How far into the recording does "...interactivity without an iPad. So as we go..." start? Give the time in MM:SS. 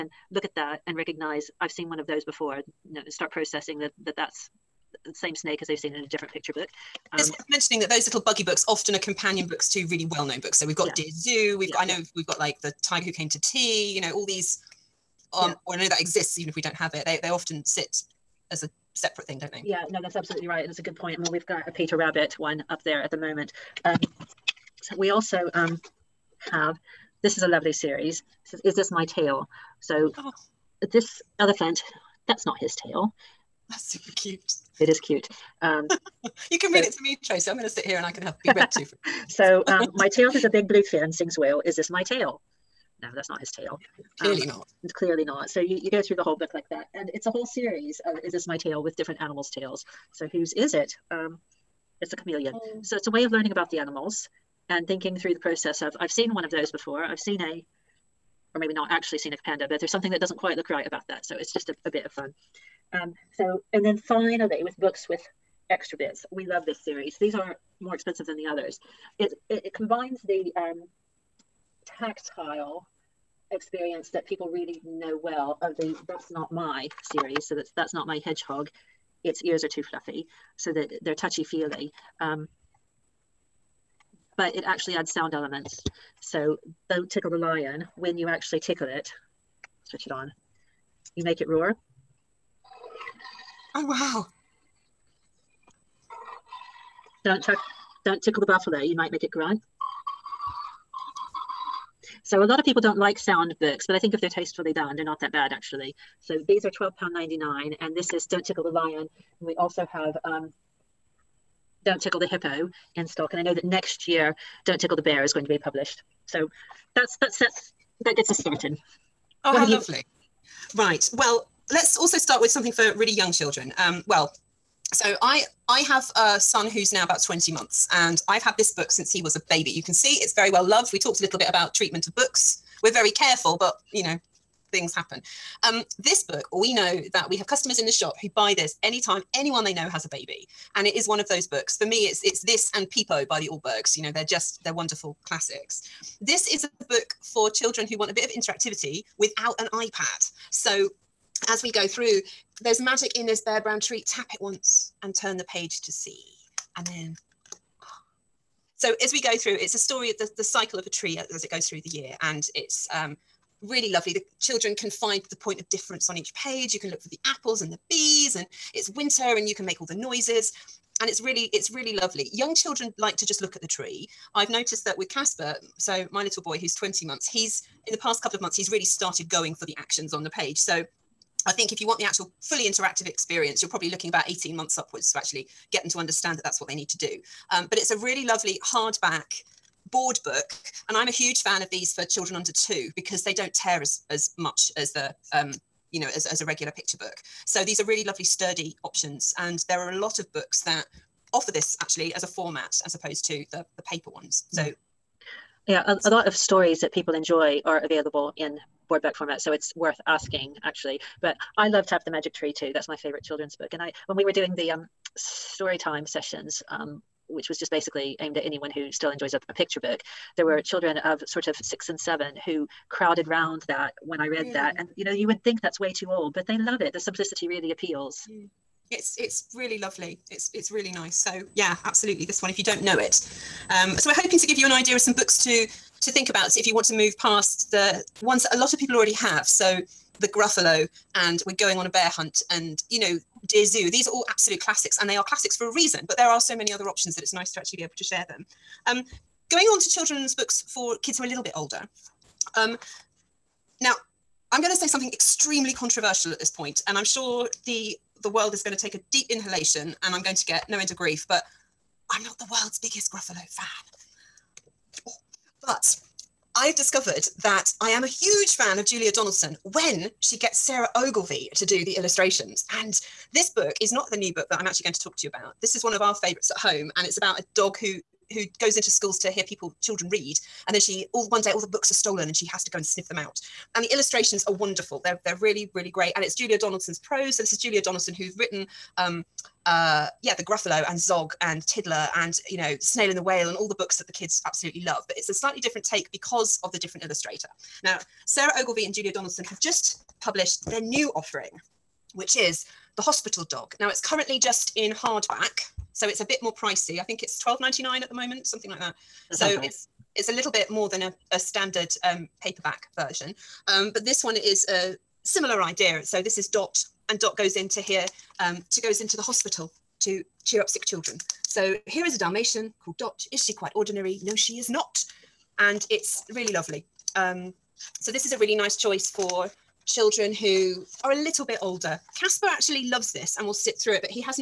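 02:28.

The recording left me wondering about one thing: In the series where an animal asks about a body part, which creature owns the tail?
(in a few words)
Chameleon.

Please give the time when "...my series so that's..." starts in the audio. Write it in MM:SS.
01:16.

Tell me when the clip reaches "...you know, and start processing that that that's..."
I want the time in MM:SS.
00:02.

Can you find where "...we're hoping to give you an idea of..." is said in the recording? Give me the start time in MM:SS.
03:54.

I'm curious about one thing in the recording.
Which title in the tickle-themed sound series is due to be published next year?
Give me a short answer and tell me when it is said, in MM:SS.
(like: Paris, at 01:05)
Don't Tickle the Bear, at 01:54.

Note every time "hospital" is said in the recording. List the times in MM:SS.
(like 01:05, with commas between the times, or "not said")
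05:03, 05:19.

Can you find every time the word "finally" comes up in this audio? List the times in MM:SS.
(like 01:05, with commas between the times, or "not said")
01:03.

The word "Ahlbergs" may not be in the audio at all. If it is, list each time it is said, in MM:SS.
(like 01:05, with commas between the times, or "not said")
02:23.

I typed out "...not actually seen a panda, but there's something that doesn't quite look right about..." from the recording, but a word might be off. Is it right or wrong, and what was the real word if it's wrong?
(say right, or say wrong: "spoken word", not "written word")
right.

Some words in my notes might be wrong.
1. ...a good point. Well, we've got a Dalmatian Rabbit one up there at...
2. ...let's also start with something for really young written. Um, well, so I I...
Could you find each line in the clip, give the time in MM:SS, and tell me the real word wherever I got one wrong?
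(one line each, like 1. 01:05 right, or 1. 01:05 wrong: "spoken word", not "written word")
1. 00:20 wrong: "Peter", not "Dalmatian"
2. 02:01 wrong: "children", not "written".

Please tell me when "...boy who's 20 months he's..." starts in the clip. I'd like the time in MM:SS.
02:56.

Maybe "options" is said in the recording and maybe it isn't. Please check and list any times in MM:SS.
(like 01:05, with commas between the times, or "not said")
03:18, 04:06.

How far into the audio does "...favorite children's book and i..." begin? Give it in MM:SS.
03:32.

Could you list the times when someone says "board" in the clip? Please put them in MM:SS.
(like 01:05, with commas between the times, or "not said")
03:09, 03:28.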